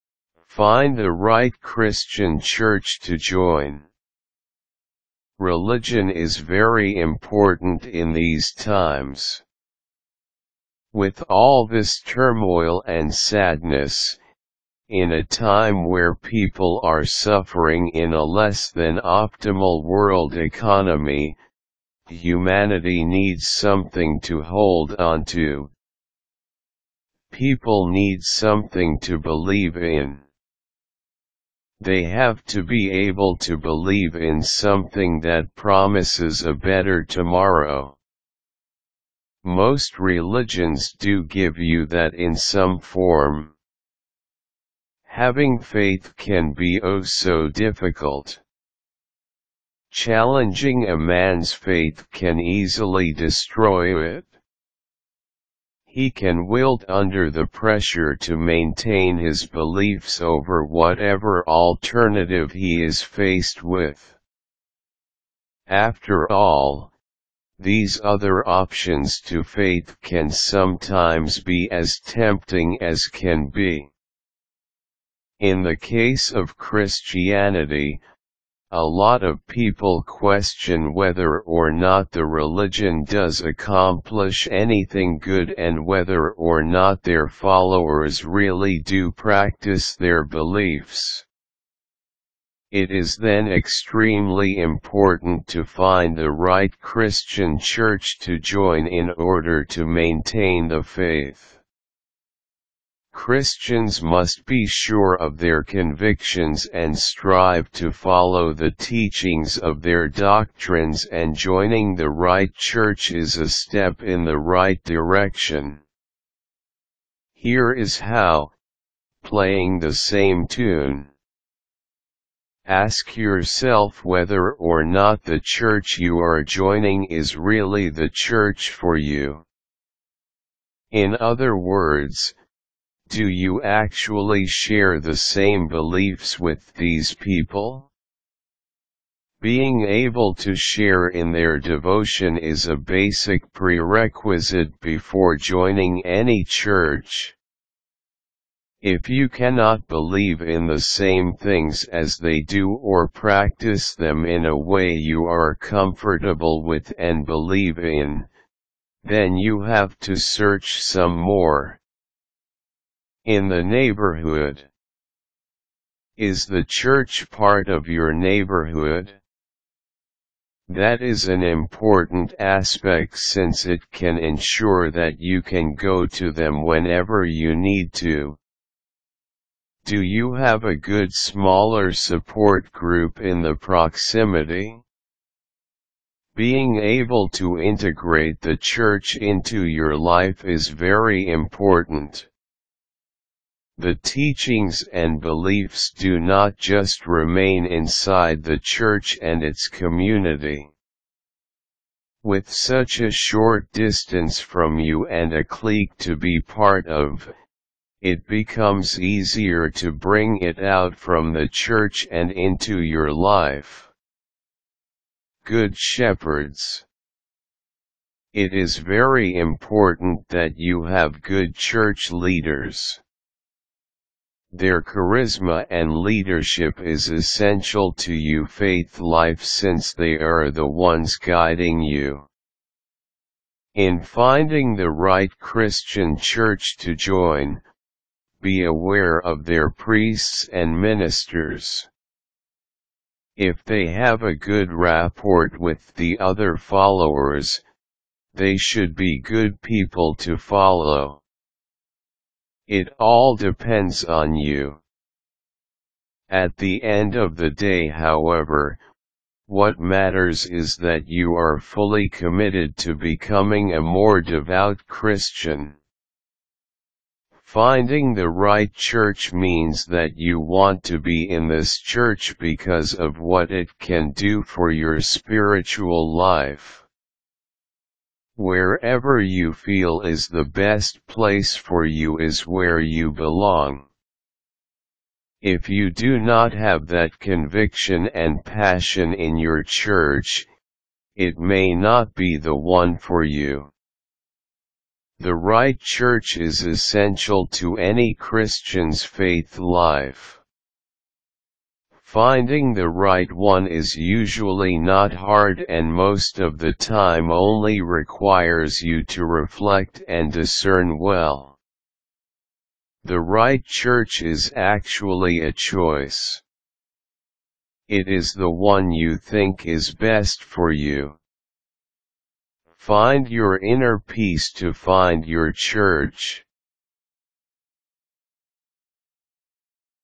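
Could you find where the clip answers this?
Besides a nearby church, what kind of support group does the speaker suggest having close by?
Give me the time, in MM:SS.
03:01.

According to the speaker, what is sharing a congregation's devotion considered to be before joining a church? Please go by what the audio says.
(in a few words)
basic prerequisite.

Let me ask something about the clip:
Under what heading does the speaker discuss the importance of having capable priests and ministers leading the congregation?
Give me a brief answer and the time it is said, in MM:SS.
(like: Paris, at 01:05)
Good Shepherds, at 03:35.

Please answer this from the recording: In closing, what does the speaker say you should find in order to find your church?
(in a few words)
inner peace.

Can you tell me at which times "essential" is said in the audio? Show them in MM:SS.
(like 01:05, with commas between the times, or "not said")
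03:47, 04:56.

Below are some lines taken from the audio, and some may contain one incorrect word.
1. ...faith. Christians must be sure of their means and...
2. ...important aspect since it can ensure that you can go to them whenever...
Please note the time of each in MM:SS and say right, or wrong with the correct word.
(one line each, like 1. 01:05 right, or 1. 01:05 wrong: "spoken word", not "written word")
1. 01:40 wrong: "convictions", not "means"
2. 02:51 right.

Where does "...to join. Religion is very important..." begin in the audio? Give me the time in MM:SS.
00:03.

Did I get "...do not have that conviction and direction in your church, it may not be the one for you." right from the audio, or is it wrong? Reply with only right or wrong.
wrong.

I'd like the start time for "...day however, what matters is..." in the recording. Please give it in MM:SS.
04:17.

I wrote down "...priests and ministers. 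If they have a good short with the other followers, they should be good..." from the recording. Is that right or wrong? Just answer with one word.
wrong.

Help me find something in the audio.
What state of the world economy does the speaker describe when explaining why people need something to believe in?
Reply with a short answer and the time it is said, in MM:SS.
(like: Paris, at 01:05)
less than optimal, at 00:18.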